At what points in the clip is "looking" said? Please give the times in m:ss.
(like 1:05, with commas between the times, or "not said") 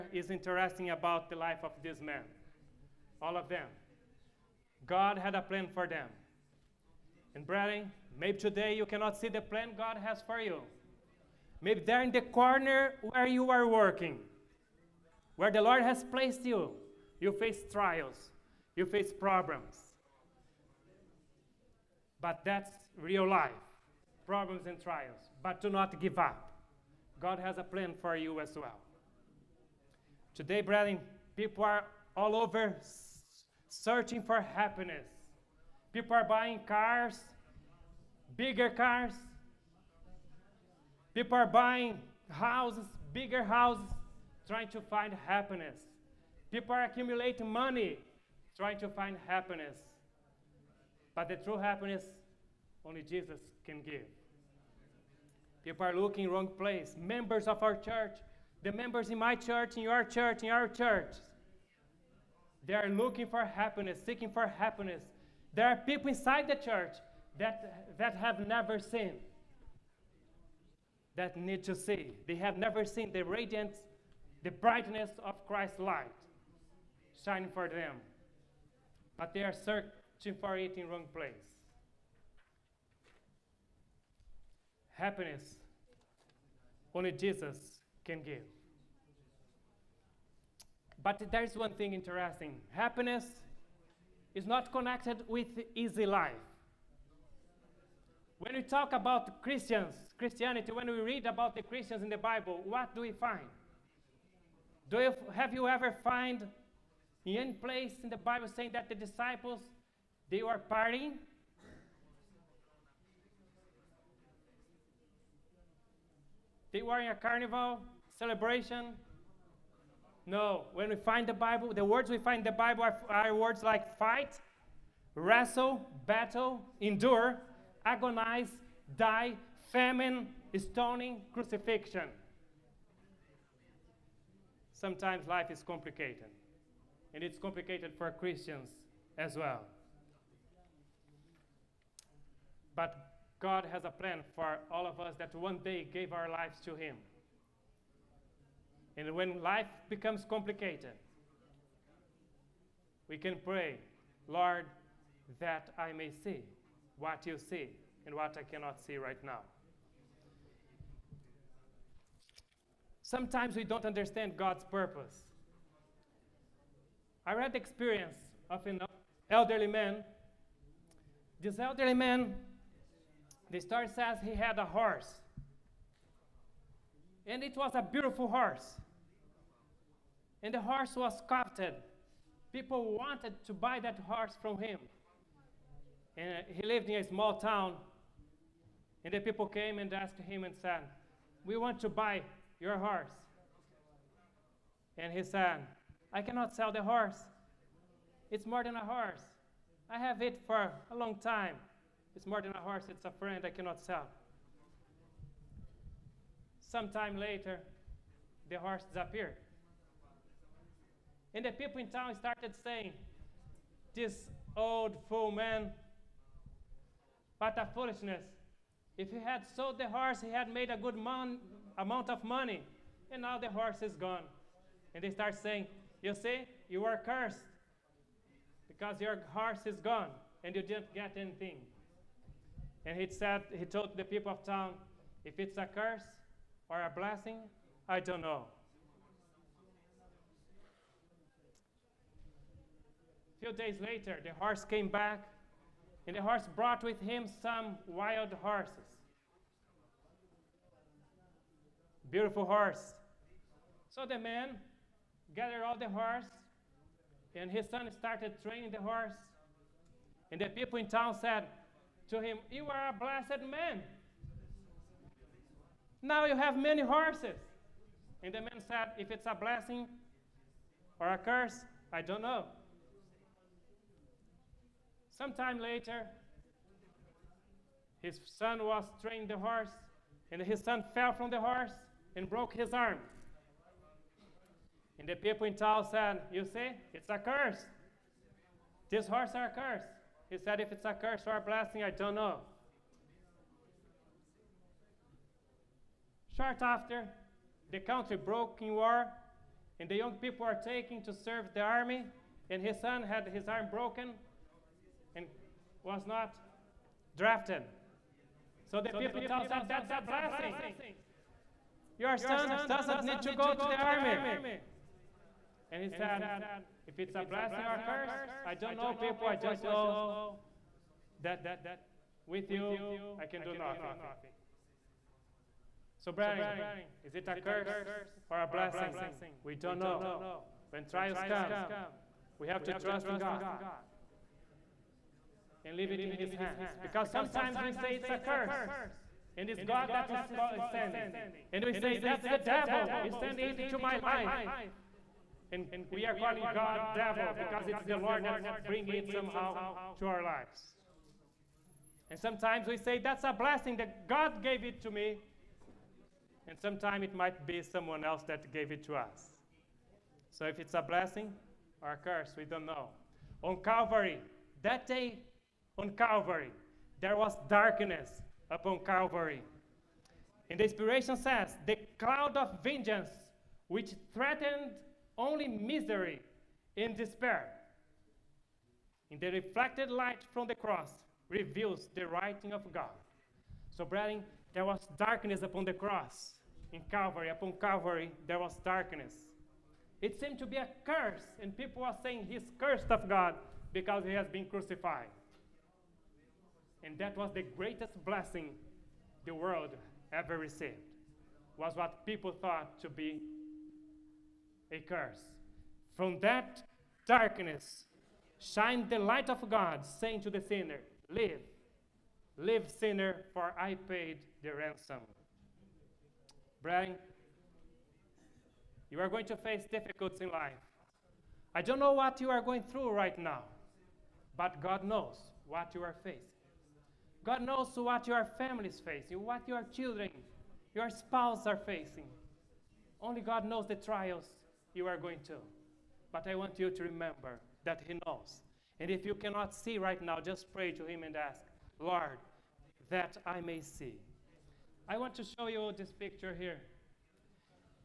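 0:55, 1:02.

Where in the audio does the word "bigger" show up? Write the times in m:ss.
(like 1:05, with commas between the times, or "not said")
0:38, 0:43.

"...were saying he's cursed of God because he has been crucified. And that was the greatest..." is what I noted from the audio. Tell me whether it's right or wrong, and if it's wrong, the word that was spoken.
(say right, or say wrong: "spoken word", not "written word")
right.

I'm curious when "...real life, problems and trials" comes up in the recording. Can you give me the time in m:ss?
0:22.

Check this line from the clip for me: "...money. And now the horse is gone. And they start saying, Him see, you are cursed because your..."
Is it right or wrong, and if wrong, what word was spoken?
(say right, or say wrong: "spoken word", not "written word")
wrong: "You", not "Him".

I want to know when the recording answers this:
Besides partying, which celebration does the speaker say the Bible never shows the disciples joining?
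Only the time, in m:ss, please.
1:57.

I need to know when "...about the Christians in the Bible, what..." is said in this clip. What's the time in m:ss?
1:41.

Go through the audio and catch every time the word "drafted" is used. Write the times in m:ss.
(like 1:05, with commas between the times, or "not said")
5:07.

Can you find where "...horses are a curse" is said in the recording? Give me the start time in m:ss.
4:49.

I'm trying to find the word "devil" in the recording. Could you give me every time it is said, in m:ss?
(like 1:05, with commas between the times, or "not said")
5:42, 5:46.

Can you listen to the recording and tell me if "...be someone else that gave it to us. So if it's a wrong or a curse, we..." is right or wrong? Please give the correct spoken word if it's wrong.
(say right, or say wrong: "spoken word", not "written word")
wrong: "blessing", not "wrong".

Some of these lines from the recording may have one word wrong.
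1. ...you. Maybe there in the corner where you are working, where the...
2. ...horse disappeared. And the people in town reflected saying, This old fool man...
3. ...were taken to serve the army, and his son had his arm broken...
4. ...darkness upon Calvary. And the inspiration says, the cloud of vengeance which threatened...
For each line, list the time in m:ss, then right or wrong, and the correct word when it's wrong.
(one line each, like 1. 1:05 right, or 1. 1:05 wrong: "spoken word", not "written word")
1. 0:10 right
2. 3:28 wrong: "started", not "reflected"
3. 5:00 right
4. 6:07 right.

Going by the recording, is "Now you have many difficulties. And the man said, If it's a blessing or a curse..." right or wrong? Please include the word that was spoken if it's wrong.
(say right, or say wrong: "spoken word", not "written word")
wrong: "horses", not "difficulties".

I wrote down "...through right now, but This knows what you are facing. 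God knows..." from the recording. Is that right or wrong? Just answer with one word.
wrong.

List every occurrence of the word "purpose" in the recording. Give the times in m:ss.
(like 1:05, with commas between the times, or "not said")
2:44.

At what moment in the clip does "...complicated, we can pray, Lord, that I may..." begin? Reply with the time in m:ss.
2:30.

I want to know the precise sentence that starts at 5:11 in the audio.
Your son doesn't need to go to the army.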